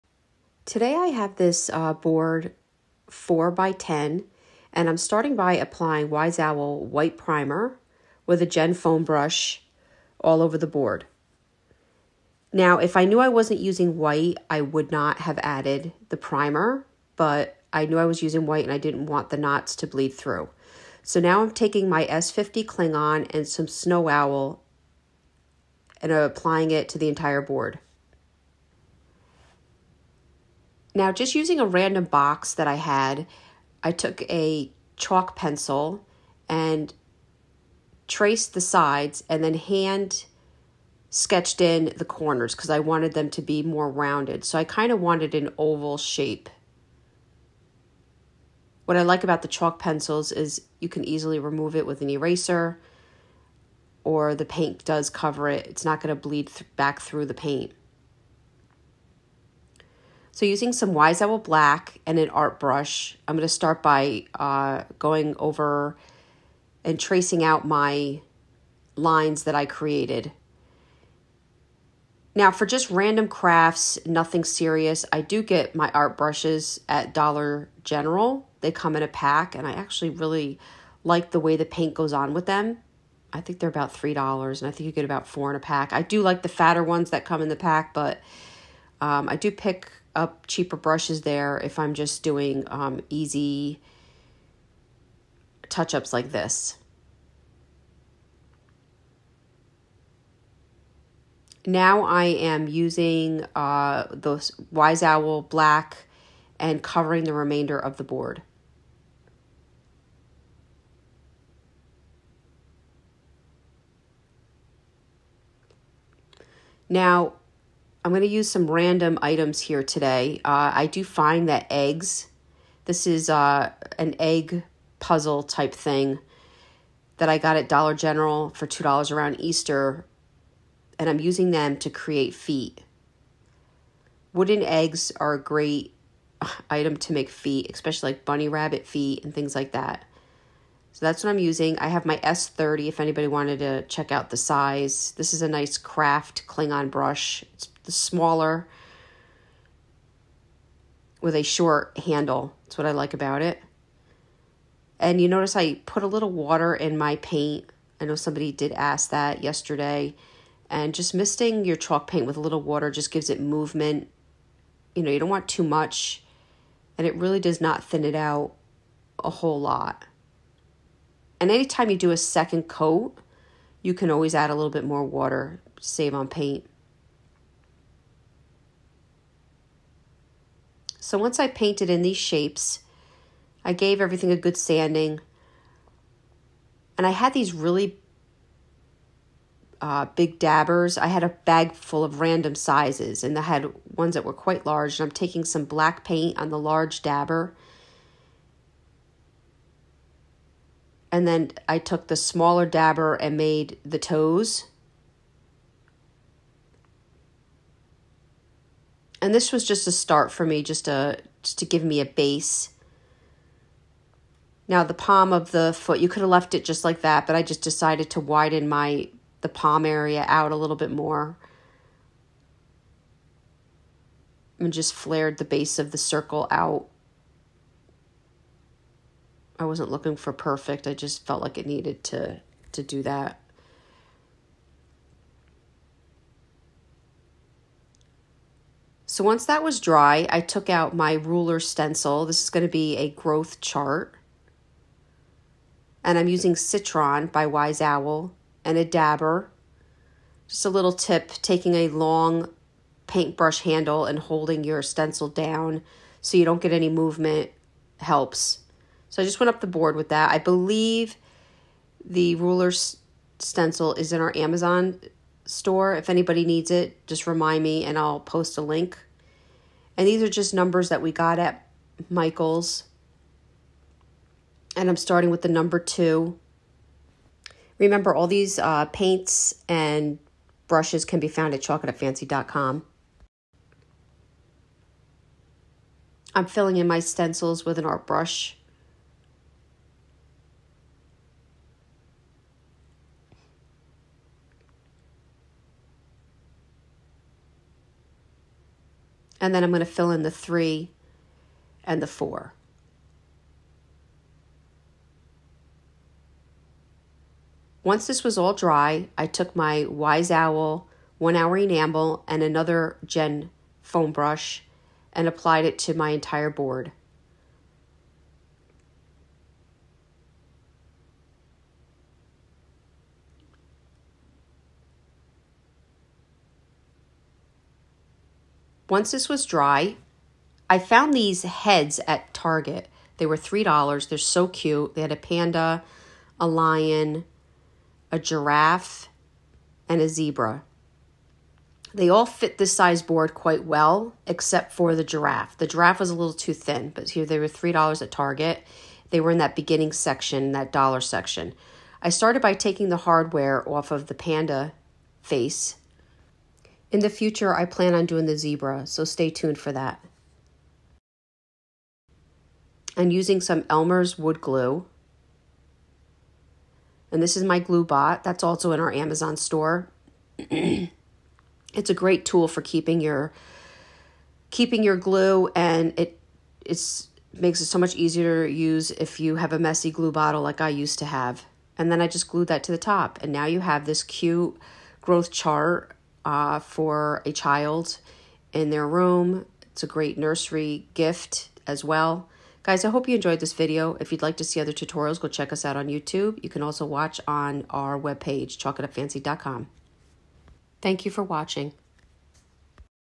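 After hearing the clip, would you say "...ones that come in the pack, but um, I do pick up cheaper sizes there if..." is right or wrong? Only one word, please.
wrong.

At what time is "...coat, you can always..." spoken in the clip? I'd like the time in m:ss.
2:52.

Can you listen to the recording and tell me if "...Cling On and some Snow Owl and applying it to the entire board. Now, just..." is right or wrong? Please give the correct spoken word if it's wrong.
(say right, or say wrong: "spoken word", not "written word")
right.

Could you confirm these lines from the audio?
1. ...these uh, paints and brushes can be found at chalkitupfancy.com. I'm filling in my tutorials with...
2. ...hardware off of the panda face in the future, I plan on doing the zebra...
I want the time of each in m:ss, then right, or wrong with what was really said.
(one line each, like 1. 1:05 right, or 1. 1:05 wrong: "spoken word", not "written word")
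1. 4:38 wrong: "stencils", not "tutorials"
2. 5:52 right.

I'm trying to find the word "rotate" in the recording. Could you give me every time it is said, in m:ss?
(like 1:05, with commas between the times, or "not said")
not said.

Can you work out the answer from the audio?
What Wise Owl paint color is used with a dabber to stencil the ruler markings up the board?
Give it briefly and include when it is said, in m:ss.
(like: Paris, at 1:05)
Citron, at 4:06.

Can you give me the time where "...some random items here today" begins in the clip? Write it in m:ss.
1:58.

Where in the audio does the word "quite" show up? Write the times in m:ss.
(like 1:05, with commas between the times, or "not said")
3:14, 5:43.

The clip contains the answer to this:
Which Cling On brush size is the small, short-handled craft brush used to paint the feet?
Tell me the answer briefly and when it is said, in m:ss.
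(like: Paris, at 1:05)
S30, at 2:22.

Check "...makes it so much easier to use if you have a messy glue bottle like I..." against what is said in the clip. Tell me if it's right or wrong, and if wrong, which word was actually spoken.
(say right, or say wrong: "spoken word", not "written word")
right.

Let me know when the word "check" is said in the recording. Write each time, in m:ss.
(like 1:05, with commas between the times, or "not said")
2:23, 6:35.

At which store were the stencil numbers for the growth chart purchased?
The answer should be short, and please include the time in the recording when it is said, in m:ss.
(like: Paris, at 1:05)
Michael's, at 4:32.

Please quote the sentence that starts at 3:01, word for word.
So once I painted in these shapes, I gave everything a good sanding.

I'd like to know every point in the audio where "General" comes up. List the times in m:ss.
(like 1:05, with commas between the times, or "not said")
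1:17, 2:07.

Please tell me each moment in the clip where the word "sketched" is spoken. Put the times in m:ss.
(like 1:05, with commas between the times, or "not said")
0:41.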